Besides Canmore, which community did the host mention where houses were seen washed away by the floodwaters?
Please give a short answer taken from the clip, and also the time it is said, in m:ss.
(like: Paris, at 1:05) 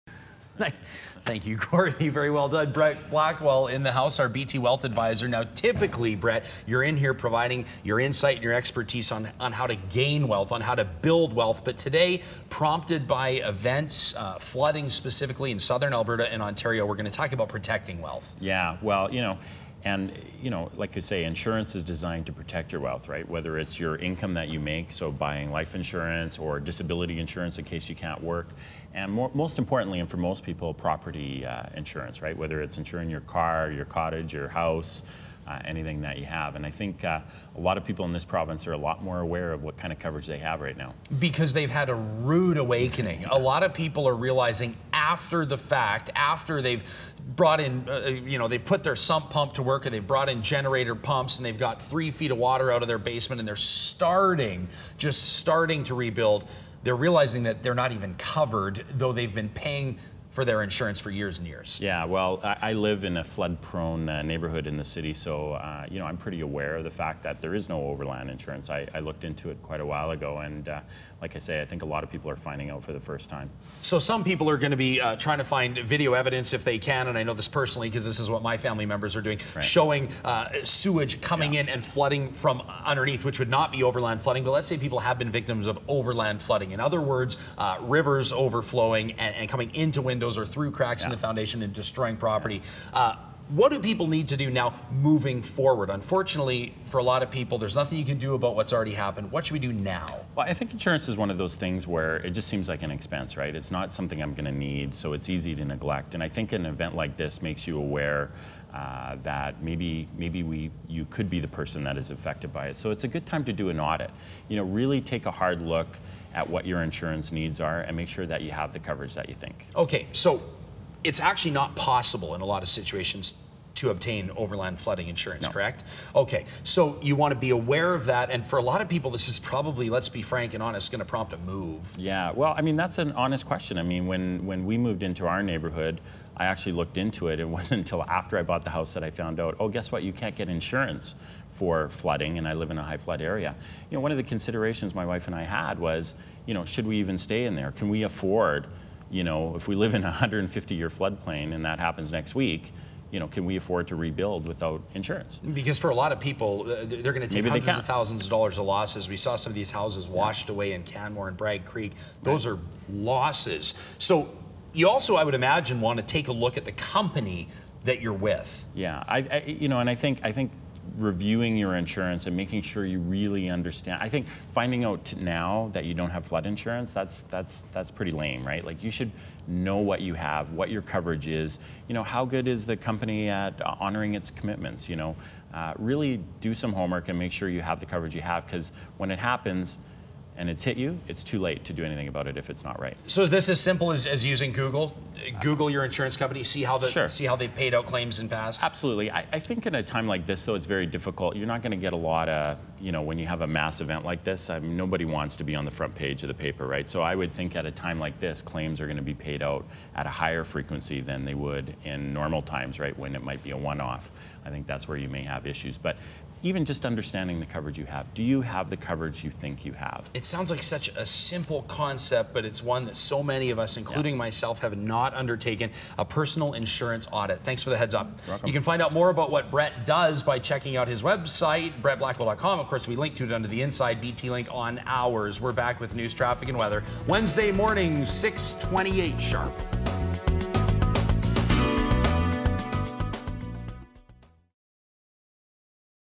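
Bragg Creek, at 2:41.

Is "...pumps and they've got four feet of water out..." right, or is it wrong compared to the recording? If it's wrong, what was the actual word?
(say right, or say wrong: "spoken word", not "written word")
wrong: "three", not "four".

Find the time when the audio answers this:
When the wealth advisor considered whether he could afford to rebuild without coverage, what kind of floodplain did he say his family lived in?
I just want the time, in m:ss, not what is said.
2:30.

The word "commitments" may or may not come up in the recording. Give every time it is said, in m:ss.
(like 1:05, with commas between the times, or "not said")
3:04.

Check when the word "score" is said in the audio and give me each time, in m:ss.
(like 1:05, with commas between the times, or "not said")
not said.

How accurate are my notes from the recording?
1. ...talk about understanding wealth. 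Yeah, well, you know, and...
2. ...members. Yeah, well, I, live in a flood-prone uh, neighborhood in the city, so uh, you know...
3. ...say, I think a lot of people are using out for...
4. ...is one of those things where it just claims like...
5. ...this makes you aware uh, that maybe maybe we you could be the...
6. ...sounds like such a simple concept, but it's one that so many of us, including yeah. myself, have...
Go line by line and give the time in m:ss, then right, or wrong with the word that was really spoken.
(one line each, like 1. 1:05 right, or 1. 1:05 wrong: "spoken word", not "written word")
1. 0:17 wrong: "protecting", not "understanding"
2. 1:01 wrong: "years", not "members"
3. 1:11 wrong: "finding", not "using"
4. 1:41 wrong: "seems", not "claims"
5. 1:47 right
6. 3:40 right.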